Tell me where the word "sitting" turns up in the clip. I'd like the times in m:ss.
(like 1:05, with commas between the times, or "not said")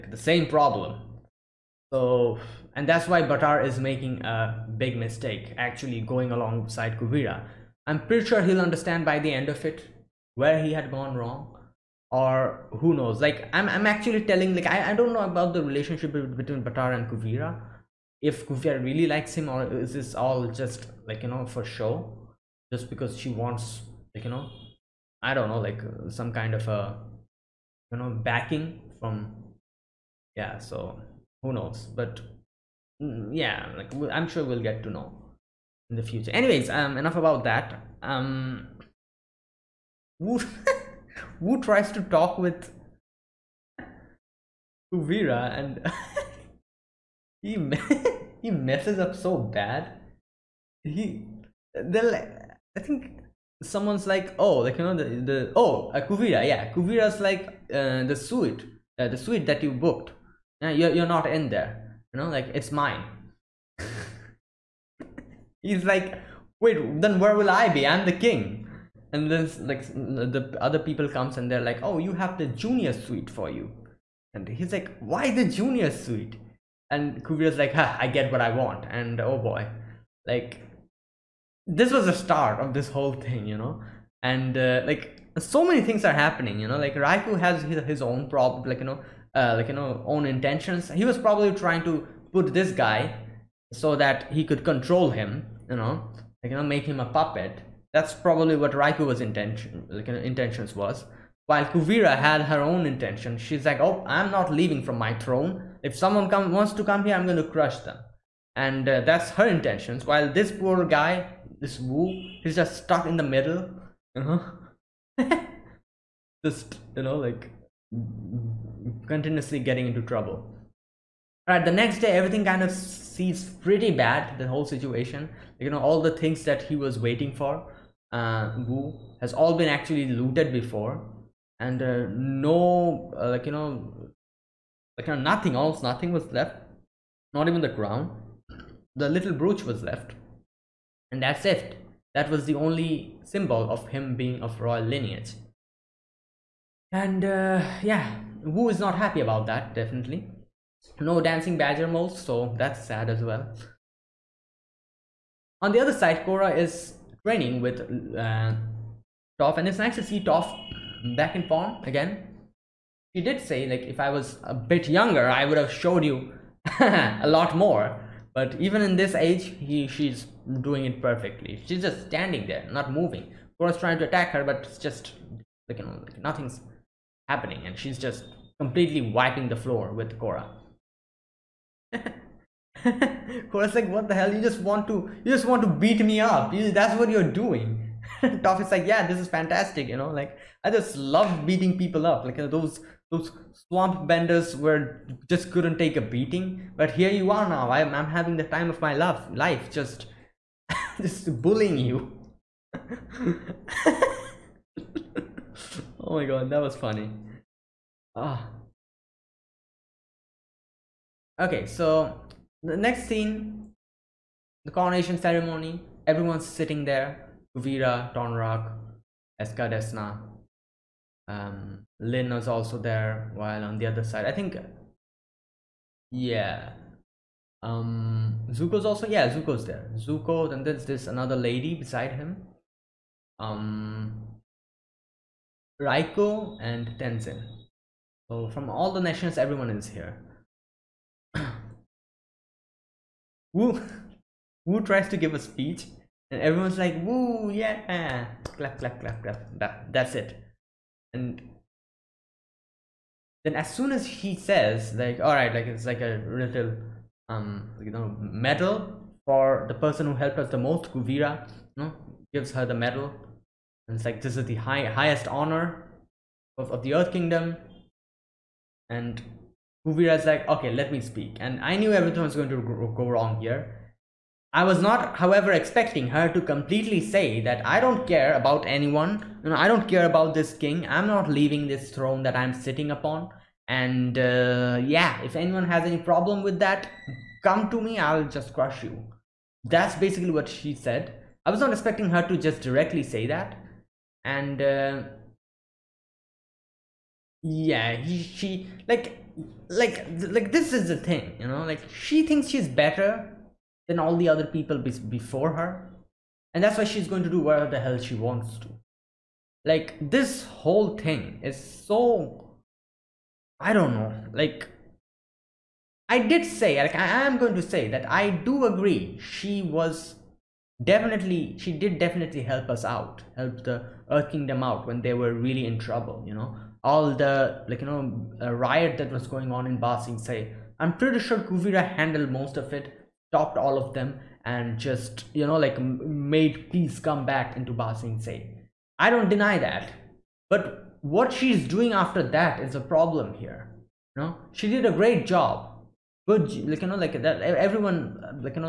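3:36, 4:42.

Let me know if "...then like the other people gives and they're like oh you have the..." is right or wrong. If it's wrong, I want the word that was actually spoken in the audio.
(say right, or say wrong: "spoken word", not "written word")
wrong: "comes", not "gives".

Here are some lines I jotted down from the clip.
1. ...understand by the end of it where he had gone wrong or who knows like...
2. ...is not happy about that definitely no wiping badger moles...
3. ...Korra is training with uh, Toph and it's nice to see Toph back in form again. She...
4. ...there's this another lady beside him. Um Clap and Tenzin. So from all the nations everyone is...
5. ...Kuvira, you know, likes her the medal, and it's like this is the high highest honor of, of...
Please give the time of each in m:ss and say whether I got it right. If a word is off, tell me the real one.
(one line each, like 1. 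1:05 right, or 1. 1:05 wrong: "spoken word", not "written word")
1. 0:08 right
2. 2:28 wrong: "dancing", not "wiping"
3. 2:36 right
4. 3:50 wrong: "Raiko", not "Clap"
5. 4:20 wrong: "gives", not "likes".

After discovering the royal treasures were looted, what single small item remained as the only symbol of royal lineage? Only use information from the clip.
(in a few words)
The little brooch.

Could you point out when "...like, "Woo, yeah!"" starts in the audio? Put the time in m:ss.
4:06.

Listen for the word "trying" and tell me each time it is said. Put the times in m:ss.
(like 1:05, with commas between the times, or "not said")
1:31, 2:53.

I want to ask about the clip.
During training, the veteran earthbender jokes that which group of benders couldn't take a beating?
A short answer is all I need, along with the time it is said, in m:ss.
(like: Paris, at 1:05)
Swamp benders, at 3:13.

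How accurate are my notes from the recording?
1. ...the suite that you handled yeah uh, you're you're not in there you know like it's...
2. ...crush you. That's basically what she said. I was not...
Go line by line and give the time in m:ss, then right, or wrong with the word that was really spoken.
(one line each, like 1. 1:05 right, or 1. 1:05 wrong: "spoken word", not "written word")
1. 0:59 wrong: "booked", not "handled"
2. 4:48 right.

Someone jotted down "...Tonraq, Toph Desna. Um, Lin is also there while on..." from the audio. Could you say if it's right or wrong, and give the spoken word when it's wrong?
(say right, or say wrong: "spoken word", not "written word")
wrong: "Eska", not "Toph".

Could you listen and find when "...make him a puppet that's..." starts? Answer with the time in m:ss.
1:36.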